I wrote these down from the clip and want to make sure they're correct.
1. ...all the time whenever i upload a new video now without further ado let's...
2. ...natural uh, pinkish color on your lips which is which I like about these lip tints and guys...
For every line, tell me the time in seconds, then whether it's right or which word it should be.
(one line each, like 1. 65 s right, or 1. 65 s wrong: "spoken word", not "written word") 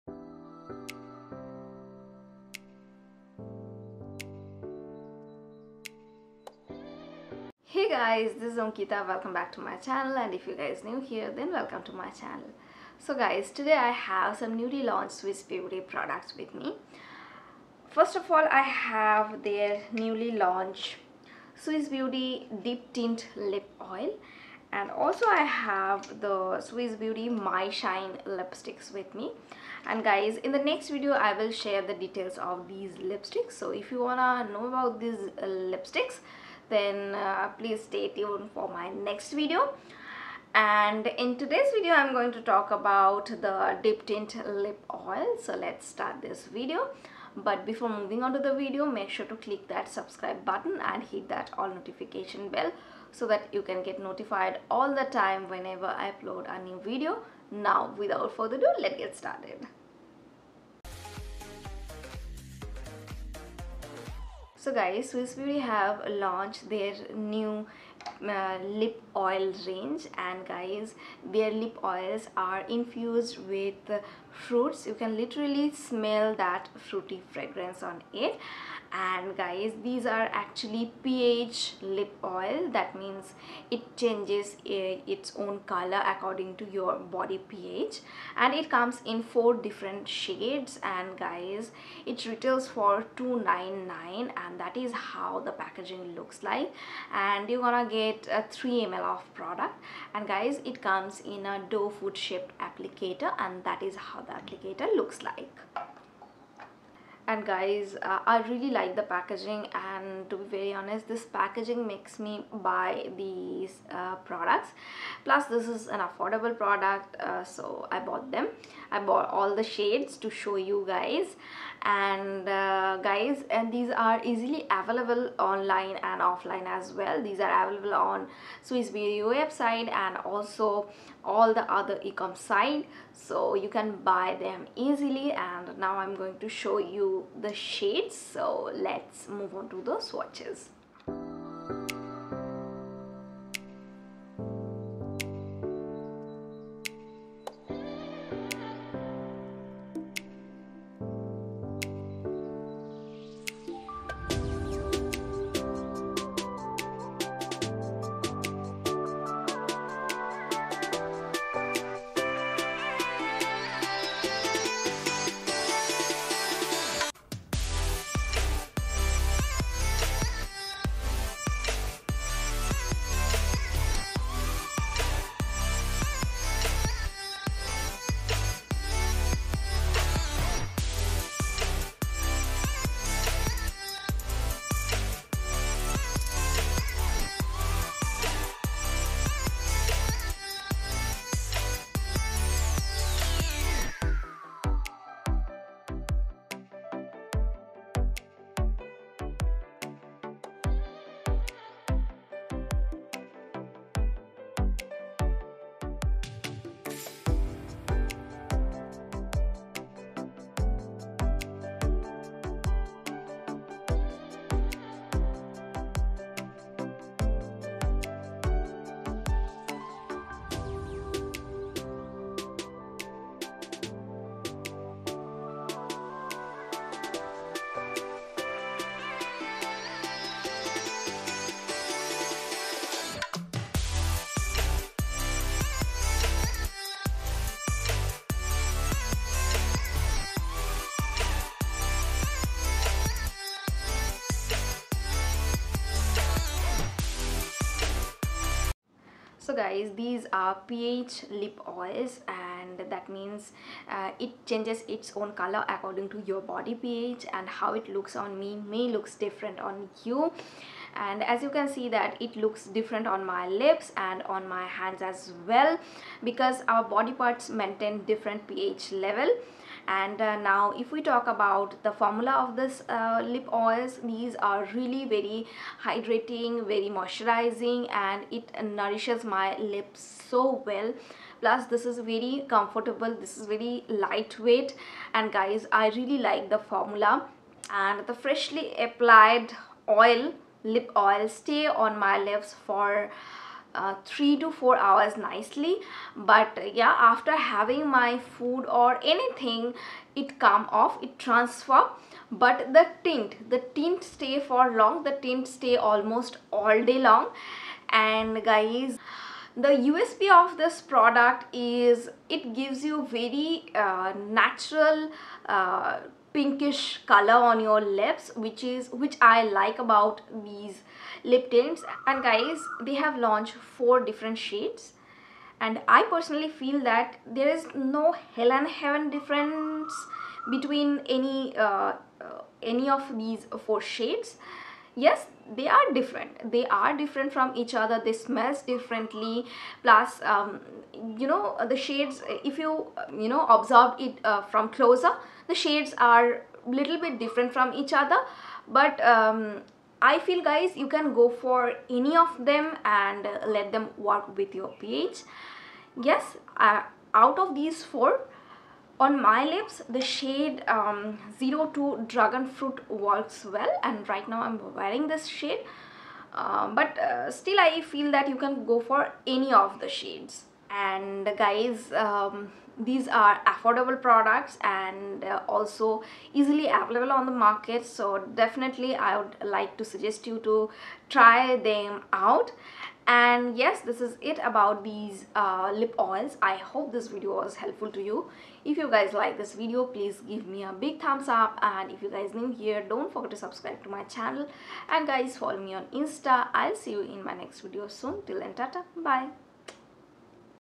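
1. 54 s right
2. 314 s right.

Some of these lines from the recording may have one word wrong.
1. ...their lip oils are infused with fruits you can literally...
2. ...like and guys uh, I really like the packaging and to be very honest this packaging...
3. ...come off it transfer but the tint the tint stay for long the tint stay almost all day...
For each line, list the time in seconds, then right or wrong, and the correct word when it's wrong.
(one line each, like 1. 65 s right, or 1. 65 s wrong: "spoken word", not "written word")
1. 71 s right
2. 105 s right
3. 300 s right.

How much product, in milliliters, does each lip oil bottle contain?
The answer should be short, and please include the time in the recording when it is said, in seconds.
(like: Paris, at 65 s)
3 ml, at 98 s.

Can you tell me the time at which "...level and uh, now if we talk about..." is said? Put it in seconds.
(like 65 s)
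268 s.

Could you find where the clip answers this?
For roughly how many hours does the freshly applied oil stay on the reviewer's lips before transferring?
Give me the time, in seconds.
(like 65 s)
294 s.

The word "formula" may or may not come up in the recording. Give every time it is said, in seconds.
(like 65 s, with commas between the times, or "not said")
271 s, 286 s.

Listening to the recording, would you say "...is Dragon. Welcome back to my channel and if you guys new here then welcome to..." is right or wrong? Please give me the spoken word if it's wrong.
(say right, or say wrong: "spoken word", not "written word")
wrong: "Ankita", not "Dragon".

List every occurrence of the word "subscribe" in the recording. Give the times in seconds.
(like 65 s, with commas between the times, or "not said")
49 s, 393 s.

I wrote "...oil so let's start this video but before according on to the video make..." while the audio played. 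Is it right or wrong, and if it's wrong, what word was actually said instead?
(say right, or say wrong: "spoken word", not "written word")
wrong: "moving", not "according".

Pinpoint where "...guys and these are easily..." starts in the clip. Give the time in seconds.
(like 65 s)
123 s.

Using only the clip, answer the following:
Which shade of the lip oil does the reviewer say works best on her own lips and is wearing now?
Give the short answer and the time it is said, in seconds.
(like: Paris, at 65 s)
02 Dragon Fruit, at 361 s.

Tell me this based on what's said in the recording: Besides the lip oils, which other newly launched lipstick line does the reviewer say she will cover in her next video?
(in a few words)
My Shine.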